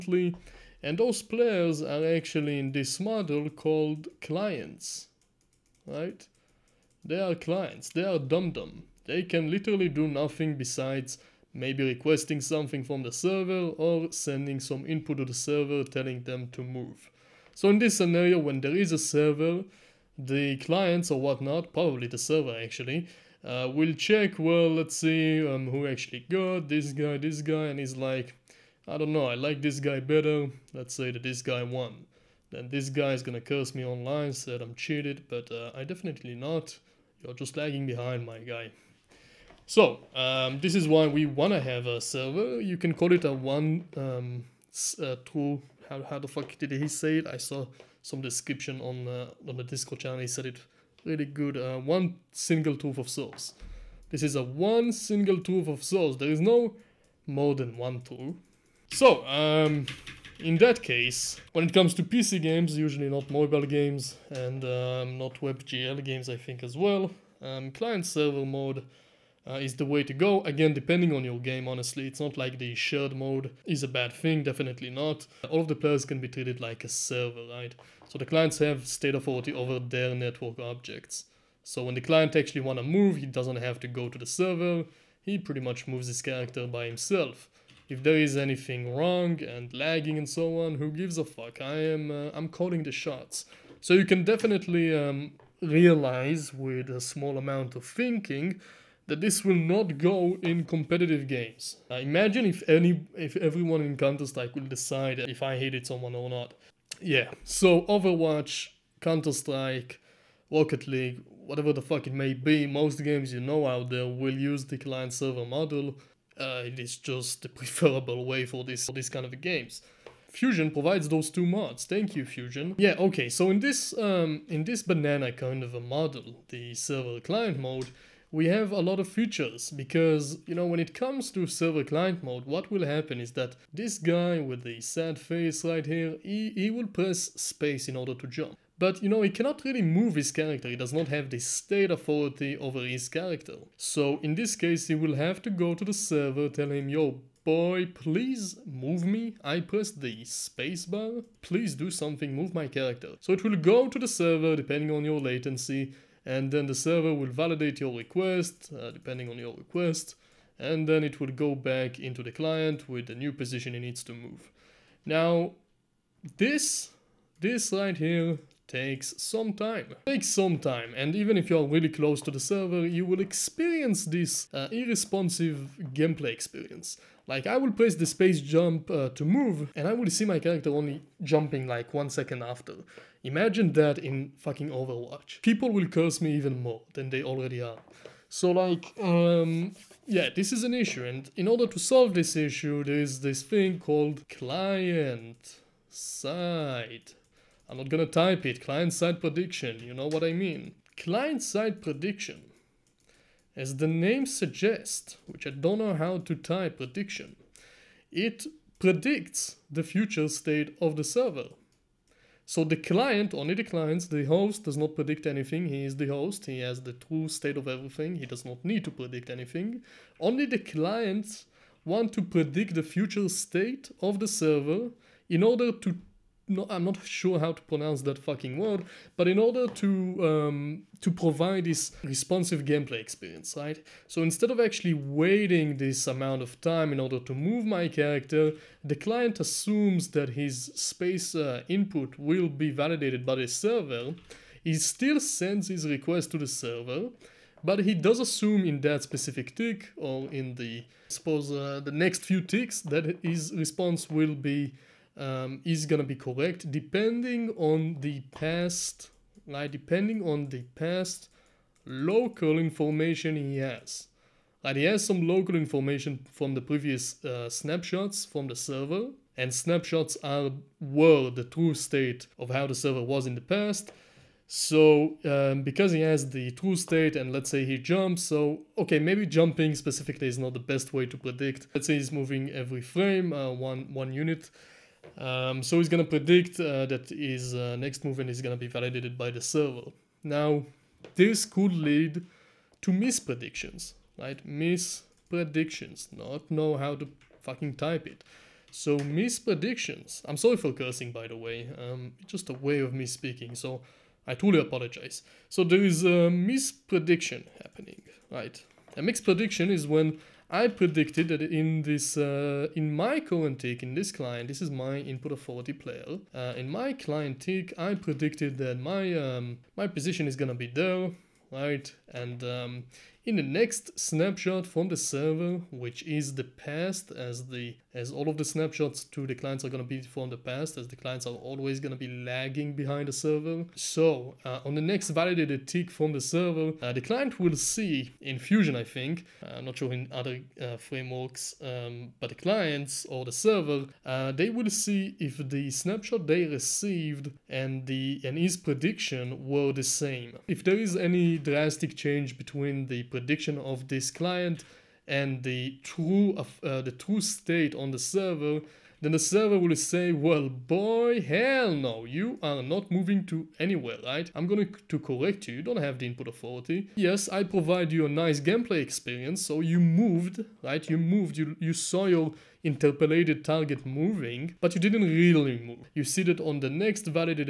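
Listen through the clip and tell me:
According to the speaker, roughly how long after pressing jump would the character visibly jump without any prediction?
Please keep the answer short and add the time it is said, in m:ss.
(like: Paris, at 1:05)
One second, at 3:01.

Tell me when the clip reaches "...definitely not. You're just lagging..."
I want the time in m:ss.
0:35.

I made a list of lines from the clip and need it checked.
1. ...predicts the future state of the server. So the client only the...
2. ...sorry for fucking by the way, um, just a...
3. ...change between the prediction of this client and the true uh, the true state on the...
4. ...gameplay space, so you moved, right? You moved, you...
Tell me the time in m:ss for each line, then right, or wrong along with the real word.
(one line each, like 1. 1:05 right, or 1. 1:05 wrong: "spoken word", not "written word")
1. 3:28 right
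2. 5:00 wrong: "cursing", not "fucking"
3. 5:51 right
4. 6:08 wrong: "experience", not "space".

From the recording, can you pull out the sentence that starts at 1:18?
So the clients have state authority over their network objects.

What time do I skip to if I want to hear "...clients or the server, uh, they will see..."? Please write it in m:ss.
5:42.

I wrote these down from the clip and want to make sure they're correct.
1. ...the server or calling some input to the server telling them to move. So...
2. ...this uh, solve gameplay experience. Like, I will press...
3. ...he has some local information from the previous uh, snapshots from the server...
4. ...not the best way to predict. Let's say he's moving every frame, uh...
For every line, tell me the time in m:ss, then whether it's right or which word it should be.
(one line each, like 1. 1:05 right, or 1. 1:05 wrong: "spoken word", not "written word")
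1. 0:13 wrong: "sending", not "calling"
2. 2:54 wrong: "irresponsive", not "solve"
3. 4:24 right
4. 4:40 right.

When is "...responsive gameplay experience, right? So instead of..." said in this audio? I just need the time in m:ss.
3:52.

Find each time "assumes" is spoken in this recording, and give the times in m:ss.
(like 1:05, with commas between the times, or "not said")
3:59, 4:08.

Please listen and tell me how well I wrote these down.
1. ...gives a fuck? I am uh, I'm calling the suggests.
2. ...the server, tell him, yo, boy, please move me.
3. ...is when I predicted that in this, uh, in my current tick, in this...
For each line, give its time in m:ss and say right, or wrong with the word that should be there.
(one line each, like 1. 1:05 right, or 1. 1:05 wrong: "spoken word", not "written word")
1. 1:30 wrong: "shots", not "suggests"
2. 2:25 right
3. 5:09 right.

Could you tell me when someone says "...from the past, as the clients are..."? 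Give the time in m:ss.
5:30.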